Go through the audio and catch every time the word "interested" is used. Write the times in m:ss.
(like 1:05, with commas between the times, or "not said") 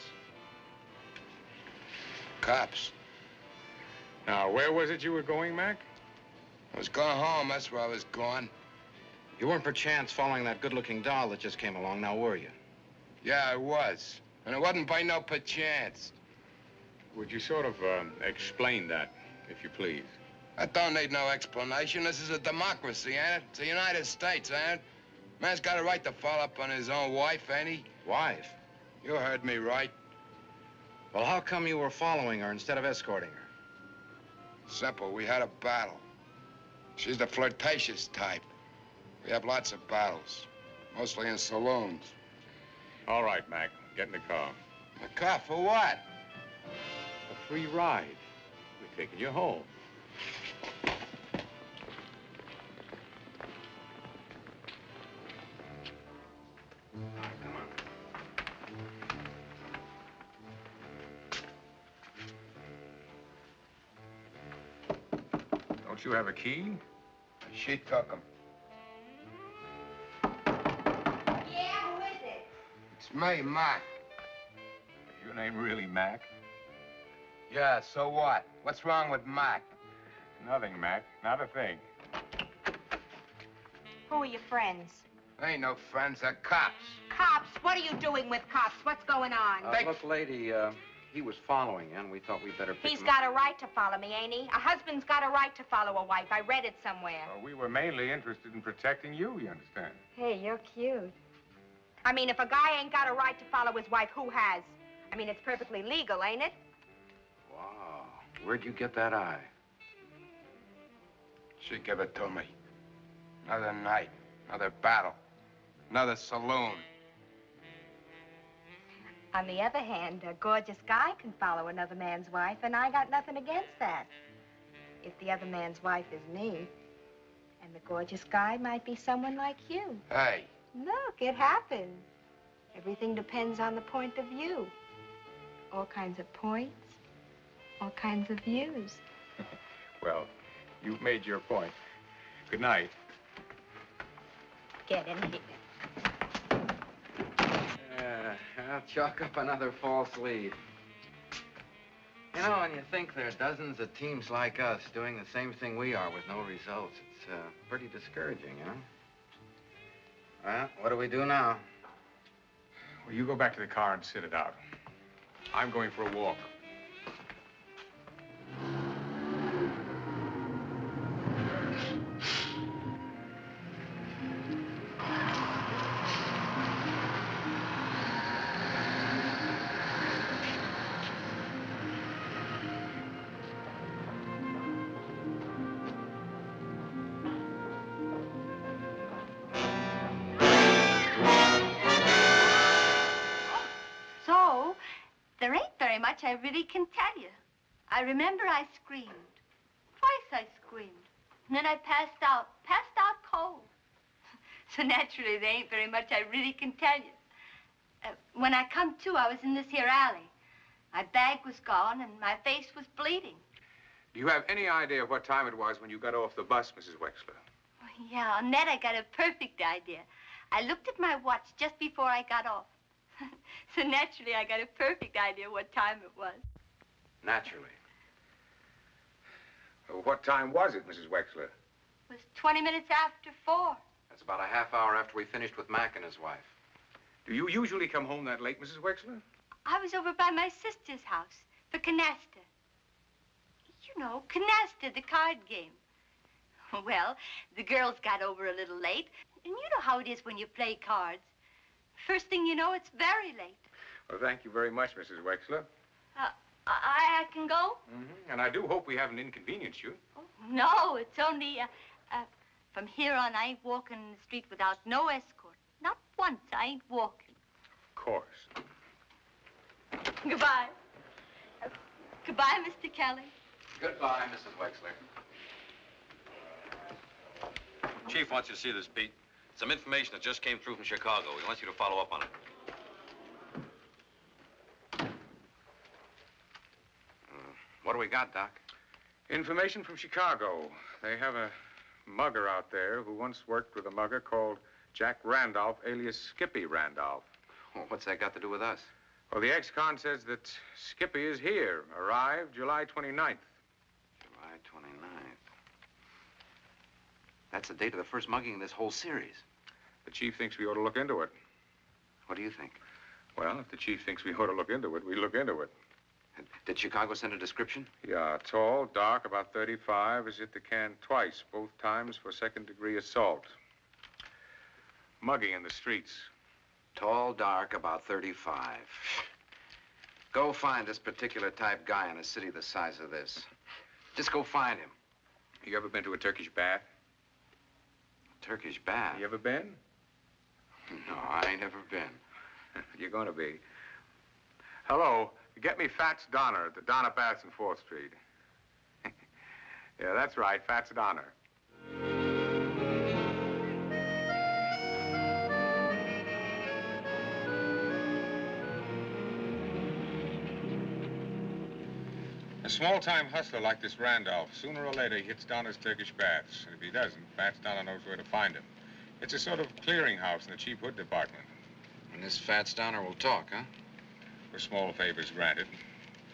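1:38.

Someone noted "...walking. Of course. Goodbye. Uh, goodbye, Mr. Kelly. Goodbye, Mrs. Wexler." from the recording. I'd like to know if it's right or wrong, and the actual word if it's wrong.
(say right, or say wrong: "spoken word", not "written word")
right.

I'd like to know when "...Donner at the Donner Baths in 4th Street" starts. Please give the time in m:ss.
5:46.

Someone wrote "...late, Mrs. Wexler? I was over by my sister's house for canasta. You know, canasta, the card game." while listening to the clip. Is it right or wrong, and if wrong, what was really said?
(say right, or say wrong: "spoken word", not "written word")
right.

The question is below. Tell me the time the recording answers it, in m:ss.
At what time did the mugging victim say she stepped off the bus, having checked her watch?
3:52.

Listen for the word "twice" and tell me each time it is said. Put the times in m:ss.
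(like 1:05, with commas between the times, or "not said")
3:19, 5:20.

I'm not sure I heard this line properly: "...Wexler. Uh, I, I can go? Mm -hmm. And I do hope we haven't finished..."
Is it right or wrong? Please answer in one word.
wrong.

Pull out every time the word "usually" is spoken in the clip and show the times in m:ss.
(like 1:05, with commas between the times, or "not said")
3:57.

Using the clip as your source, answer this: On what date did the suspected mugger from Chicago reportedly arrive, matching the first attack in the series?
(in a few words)
July 29th.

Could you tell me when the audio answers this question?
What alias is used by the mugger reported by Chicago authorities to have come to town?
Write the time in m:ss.
4:56.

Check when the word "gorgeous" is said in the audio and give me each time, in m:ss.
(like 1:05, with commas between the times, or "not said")
2:00, 2:07.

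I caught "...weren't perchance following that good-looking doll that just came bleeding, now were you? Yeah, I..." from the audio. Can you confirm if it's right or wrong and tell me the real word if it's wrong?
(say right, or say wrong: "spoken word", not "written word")
wrong: "along", not "bleeding".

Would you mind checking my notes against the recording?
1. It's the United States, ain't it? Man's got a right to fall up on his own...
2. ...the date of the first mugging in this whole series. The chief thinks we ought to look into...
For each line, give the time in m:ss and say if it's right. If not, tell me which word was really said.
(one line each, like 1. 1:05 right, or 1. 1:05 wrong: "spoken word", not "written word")
1. 0:23 right
2. 5:07 right.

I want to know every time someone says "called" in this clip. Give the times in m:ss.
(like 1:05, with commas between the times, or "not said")
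4:54.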